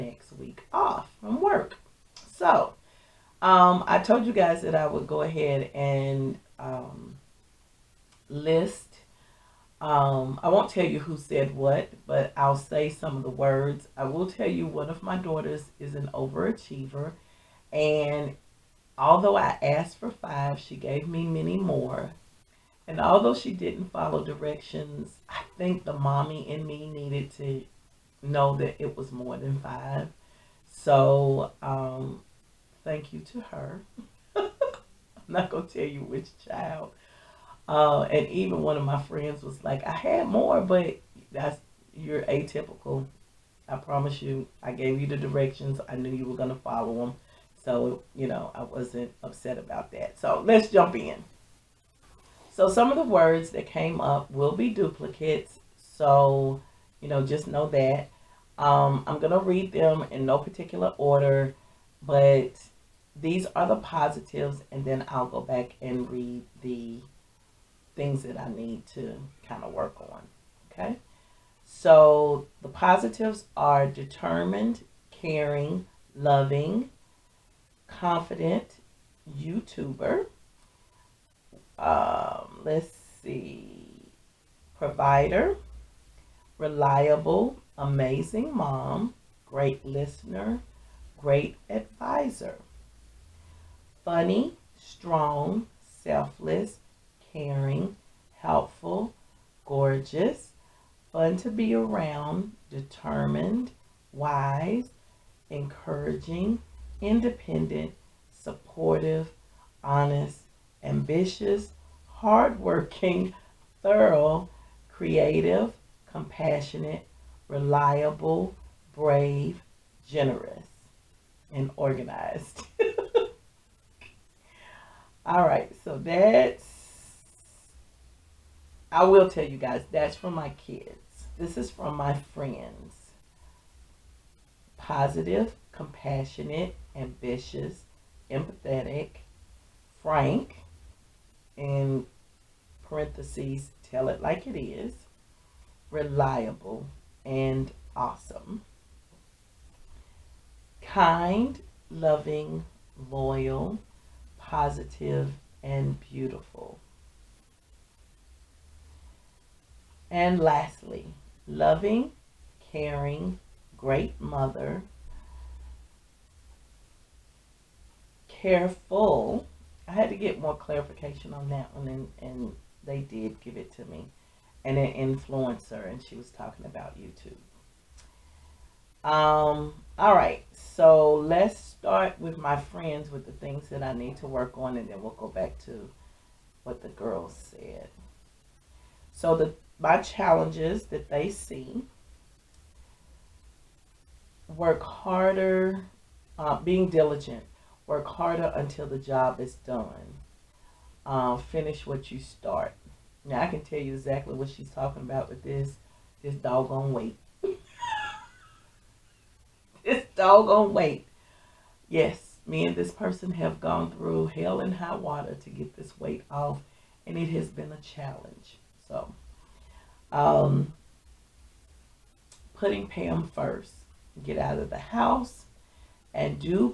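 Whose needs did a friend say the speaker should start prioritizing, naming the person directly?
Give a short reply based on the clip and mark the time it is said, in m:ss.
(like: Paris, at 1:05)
Pam, at 3:42.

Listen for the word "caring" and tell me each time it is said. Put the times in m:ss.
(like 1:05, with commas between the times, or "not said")
1:15, 1:37, 2:42.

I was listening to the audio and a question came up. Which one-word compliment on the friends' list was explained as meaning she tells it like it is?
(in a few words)
Frank.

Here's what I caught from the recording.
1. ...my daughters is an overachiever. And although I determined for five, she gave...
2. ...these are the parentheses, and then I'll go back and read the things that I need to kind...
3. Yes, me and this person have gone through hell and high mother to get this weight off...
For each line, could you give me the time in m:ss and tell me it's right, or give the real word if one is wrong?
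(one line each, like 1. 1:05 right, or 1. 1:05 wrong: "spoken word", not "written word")
1. 0:15 wrong: "asked", not "determined"
2. 1:03 wrong: "positives", not "parentheses"
3. 3:31 wrong: "water", not "mother".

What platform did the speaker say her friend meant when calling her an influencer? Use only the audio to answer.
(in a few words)
YouTube.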